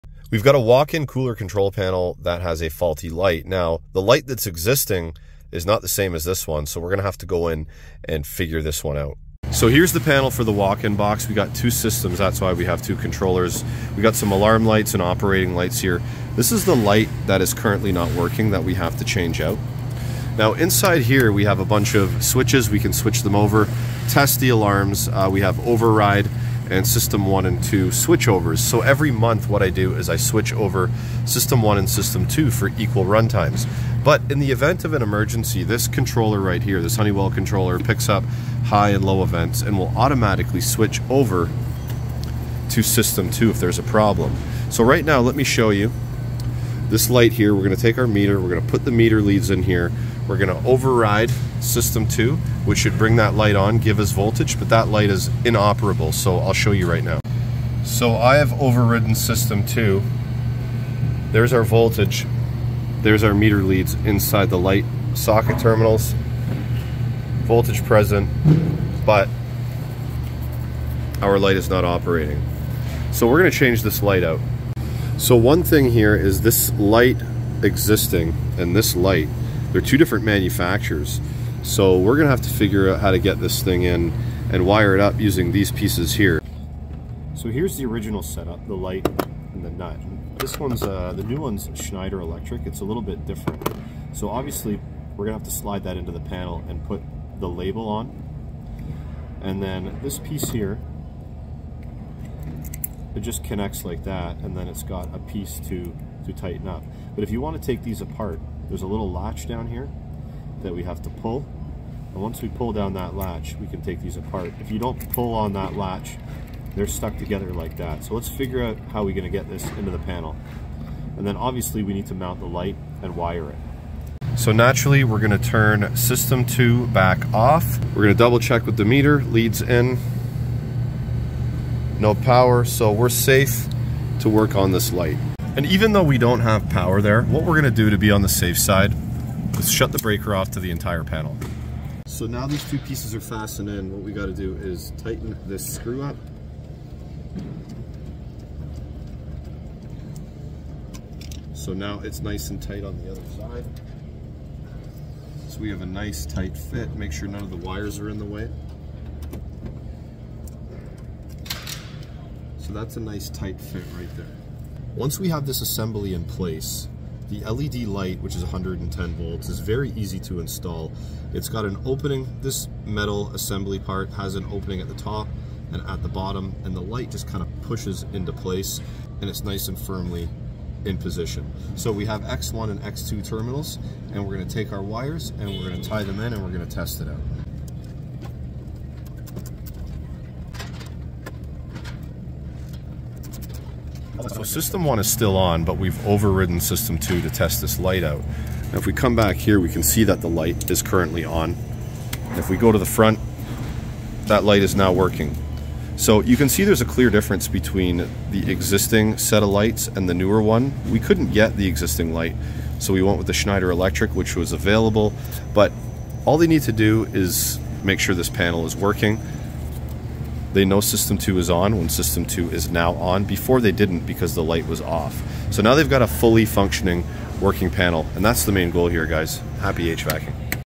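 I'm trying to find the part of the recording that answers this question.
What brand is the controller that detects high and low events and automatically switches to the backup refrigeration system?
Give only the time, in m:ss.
0:36.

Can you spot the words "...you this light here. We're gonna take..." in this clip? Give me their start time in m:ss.
0:45.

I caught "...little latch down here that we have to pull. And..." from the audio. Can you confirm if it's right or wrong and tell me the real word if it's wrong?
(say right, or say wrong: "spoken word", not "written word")
right.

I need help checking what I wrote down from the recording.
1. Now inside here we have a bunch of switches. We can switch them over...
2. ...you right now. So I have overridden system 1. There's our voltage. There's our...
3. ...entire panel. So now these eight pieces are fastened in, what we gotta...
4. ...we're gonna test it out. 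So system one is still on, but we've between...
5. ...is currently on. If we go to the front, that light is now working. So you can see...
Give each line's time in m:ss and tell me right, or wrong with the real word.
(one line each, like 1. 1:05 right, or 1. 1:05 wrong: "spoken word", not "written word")
1. 0:20 right
2. 0:56 wrong: "2", not "1"
3. 2:20 wrong: "two", not "eight"
4. 3:06 wrong: "overridden", not "between"
5. 3:20 right.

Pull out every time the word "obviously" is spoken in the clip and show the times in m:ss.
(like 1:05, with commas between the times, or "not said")
1:34, 2:01.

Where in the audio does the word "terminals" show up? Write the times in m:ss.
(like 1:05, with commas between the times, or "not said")
1:05, 3:03.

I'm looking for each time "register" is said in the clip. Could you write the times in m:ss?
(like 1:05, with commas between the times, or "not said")
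not said.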